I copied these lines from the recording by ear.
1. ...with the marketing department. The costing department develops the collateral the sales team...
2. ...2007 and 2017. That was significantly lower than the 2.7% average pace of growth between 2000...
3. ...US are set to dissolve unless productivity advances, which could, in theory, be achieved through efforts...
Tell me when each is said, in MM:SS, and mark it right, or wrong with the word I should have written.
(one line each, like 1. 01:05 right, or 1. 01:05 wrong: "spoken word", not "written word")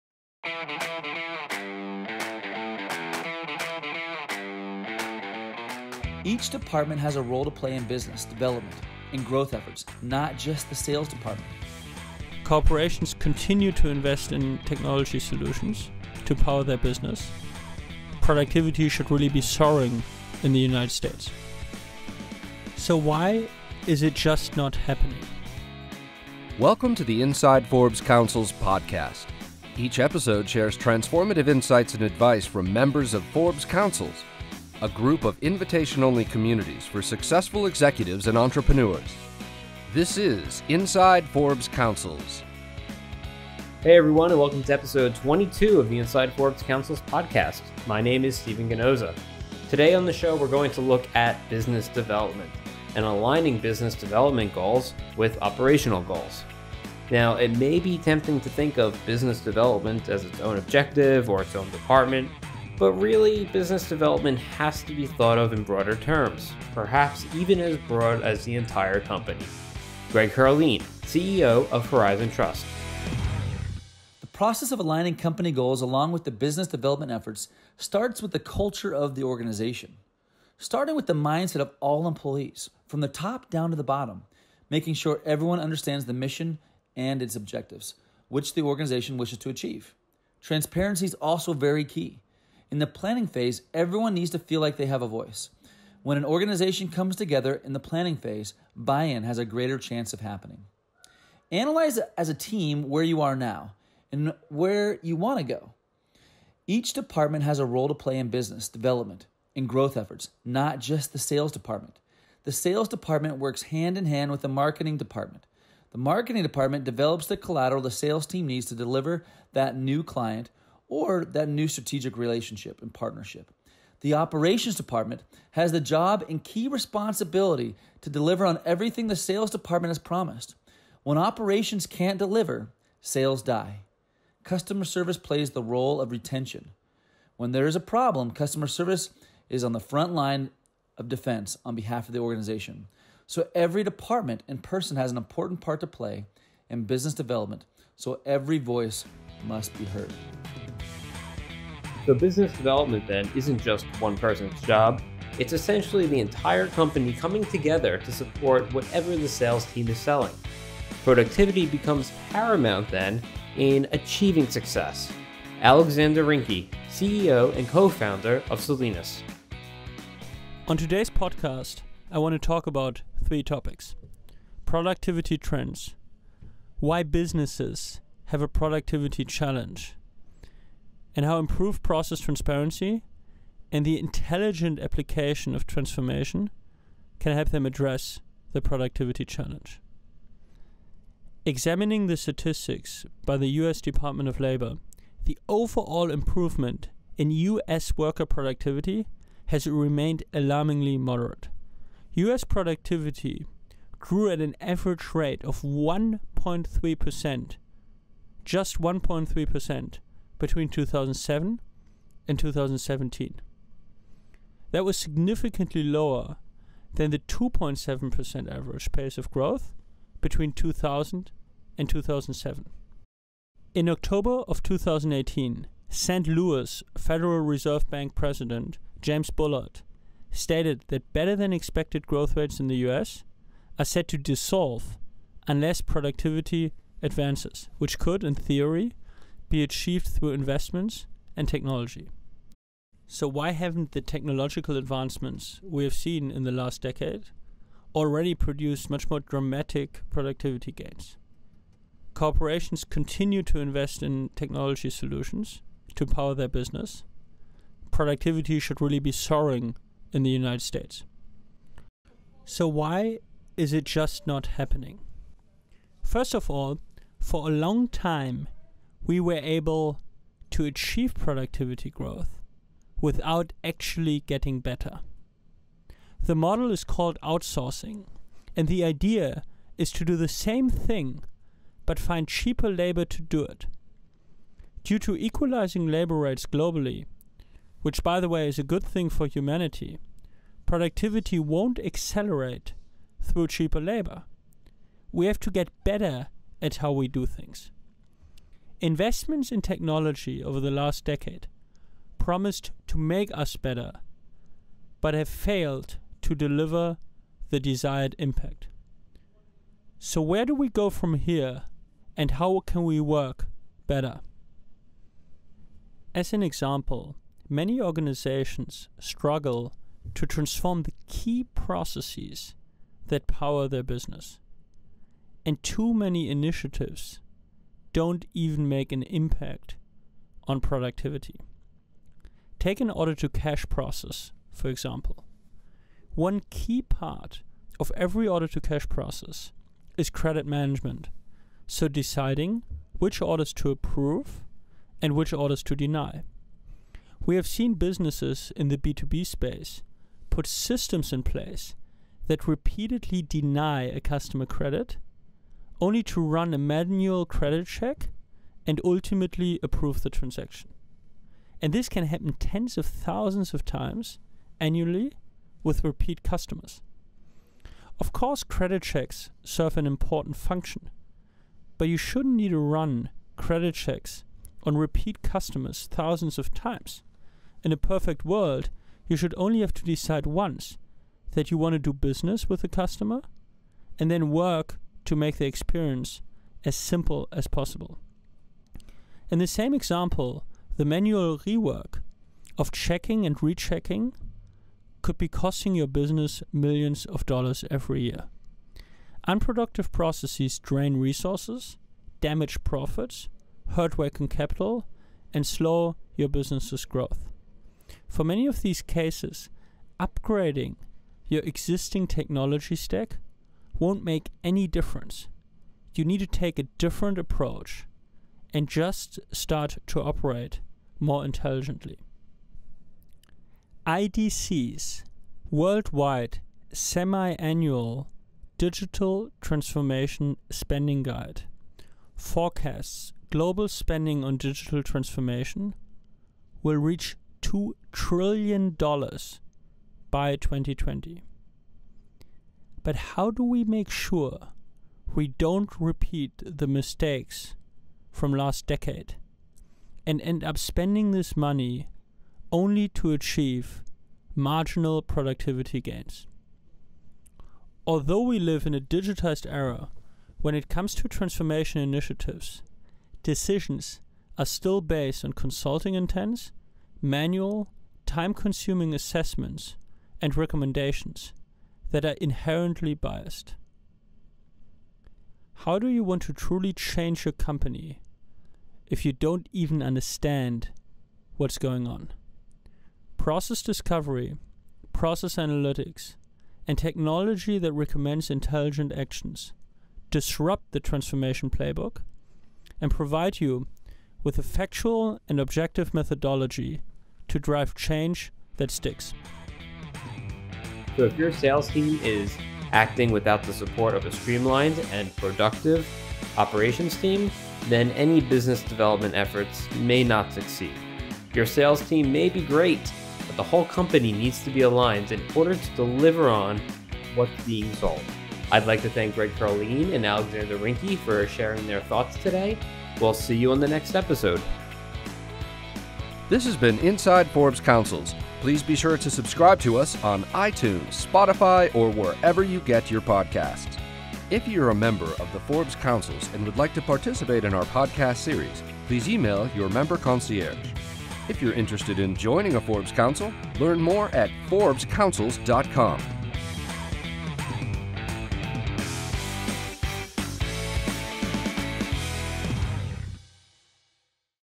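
1. 01:54 wrong: "marketing", not "costing"
2. 03:30 right
3. 03:52 wrong: "investments", not "efforts".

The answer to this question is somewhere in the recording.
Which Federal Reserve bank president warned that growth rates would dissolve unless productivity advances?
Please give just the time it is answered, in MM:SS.
03:49.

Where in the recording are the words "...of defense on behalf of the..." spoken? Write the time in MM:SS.
02:20.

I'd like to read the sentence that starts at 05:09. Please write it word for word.
So, where do we go from here, and how can we work better?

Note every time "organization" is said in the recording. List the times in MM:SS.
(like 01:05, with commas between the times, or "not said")
01:19, 01:28, 01:36, 02:22, 05:17.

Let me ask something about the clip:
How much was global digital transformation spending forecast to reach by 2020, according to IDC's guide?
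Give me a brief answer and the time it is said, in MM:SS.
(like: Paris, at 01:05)
$2 trillion, at 07:17.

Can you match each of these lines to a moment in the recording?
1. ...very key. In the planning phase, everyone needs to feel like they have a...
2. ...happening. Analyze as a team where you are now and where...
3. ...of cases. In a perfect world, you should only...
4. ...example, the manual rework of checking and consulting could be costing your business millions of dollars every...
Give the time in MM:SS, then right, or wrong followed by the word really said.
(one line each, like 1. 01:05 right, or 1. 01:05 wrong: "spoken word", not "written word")
1. 01:31 right
2. 01:40 right
3. 06:16 wrong: "times", not "cases"
4. 06:29 wrong: "rechecking", not "consulting".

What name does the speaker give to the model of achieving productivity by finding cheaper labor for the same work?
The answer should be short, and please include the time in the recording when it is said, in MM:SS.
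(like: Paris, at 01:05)
outsourcing, at 04:37.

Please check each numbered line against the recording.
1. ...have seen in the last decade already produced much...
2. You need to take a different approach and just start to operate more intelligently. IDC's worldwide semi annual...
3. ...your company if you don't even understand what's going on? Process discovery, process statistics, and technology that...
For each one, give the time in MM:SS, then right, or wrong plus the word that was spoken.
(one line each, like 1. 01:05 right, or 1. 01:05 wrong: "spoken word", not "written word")
1. 04:05 right
2. 06:55 right
3. 07:57 wrong: "analytics", not "statistics".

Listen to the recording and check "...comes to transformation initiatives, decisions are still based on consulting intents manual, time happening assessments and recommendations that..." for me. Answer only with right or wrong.
wrong.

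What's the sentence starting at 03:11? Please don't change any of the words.
Examining the statistics by the US Department of Labor, the overall improvement in US worker productivity has remained alarmingly moderate.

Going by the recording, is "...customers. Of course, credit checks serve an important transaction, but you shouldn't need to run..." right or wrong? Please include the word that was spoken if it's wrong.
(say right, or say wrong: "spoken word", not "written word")
wrong: "function", not "transaction".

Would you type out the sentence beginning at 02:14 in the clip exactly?
Customer service plays the role of retention.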